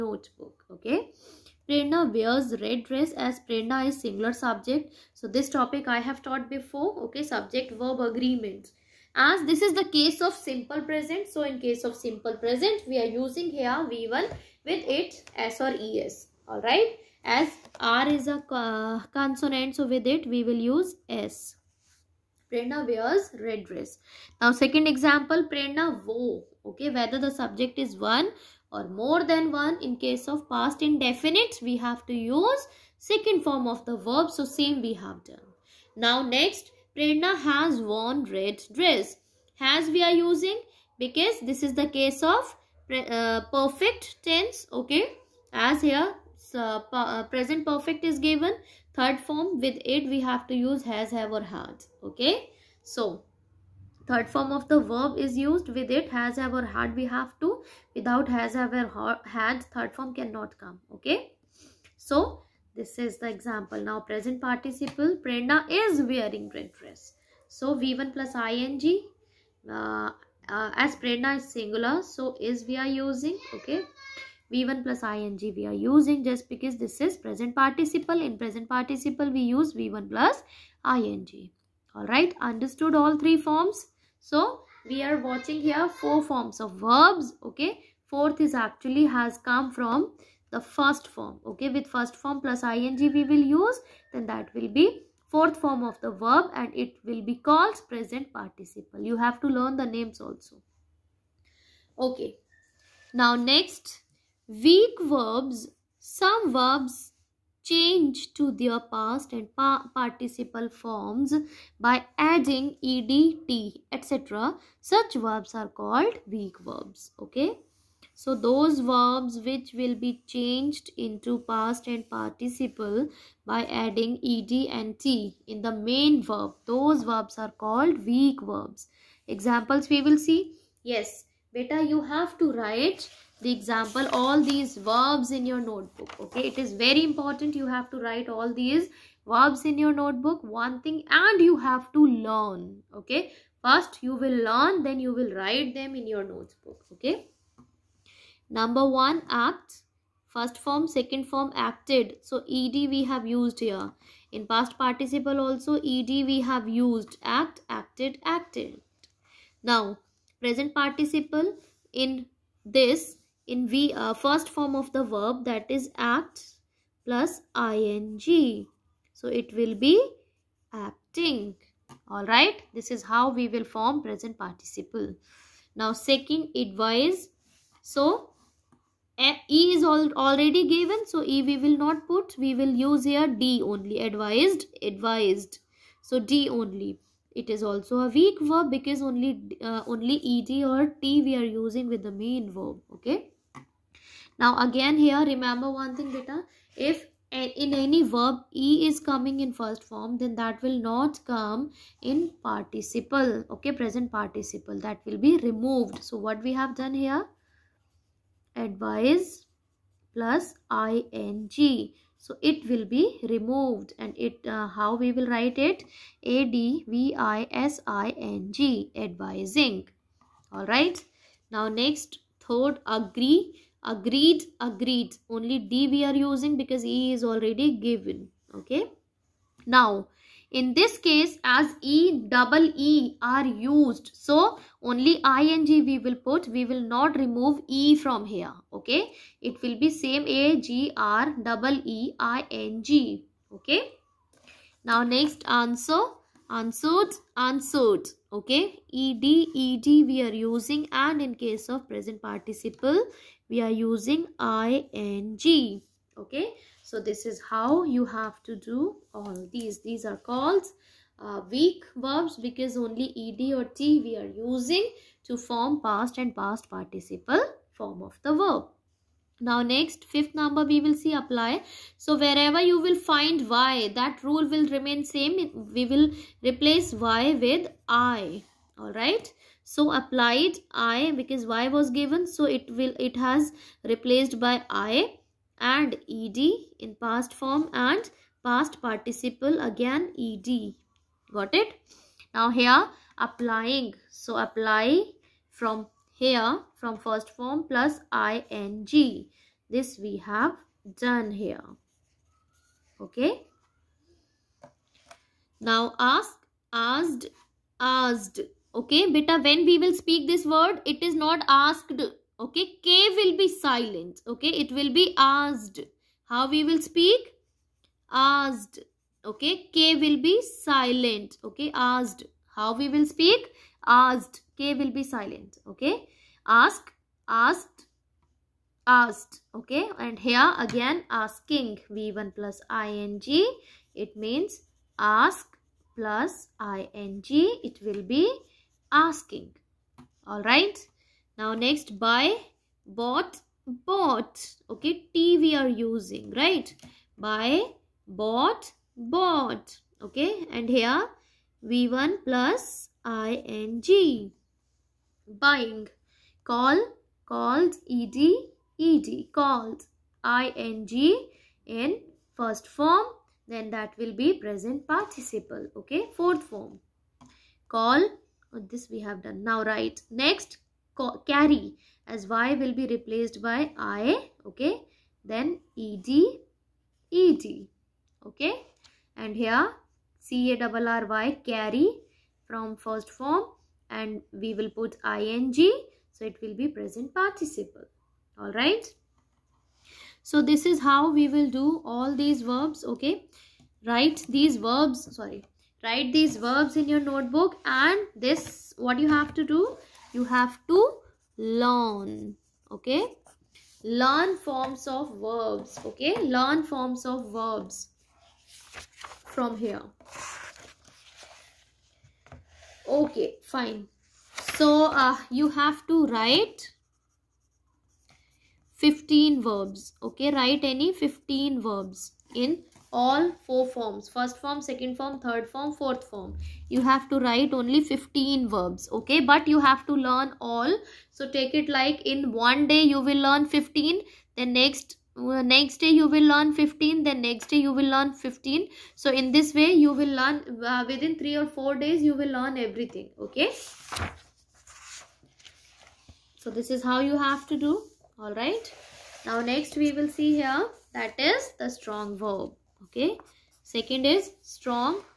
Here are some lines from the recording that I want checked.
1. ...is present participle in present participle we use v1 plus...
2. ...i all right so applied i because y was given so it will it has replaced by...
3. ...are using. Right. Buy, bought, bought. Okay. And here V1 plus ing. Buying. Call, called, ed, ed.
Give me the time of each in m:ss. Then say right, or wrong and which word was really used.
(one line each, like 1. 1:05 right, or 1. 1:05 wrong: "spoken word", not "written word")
1. 1:16 right
2. 4:37 right
3. 5:45 right.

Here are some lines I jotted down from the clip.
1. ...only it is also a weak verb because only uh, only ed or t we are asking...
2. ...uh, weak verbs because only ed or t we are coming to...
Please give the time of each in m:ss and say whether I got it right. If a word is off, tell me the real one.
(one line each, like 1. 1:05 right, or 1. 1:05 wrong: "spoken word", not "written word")
1. 3:06 wrong: "using", not "asking"
2. 4:21 wrong: "using", not "coming".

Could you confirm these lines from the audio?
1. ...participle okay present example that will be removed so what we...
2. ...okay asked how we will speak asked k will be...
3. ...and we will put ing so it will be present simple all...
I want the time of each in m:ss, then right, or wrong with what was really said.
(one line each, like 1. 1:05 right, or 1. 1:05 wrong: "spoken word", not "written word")
1. 3:22 wrong: "participle", not "example"
2. 5:21 right
3. 6:23 wrong: "participle", not "simple".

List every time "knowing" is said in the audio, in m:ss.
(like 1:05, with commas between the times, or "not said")
not said.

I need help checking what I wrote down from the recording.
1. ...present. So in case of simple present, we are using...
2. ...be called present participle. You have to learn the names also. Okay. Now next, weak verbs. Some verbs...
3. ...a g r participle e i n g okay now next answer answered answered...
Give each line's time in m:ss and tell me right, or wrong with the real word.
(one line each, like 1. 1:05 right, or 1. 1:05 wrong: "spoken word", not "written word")
1. 0:10 right
2. 1:37 right
3. 4:00 wrong: "double", not "participle".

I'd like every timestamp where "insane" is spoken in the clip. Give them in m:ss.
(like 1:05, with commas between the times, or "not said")
not said.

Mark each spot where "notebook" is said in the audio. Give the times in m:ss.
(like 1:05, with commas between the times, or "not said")
2:15, 2:19, 2:26, 6:36.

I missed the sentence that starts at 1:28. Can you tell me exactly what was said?
Fourth is actually has come from the first form, okay.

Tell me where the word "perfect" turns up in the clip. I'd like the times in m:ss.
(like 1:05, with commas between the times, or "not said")
0:43, 0:47.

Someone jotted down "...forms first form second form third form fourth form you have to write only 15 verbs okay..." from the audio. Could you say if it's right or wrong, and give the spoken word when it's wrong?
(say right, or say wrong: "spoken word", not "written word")
right.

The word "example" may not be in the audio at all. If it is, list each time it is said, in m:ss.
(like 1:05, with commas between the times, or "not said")
0:24, 1:03, 2:09, 2:13.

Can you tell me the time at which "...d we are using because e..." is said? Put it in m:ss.
3:45.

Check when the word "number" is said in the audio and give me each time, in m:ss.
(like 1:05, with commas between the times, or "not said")
2:28, 4:30.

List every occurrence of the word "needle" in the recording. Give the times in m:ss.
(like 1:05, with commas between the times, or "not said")
not said.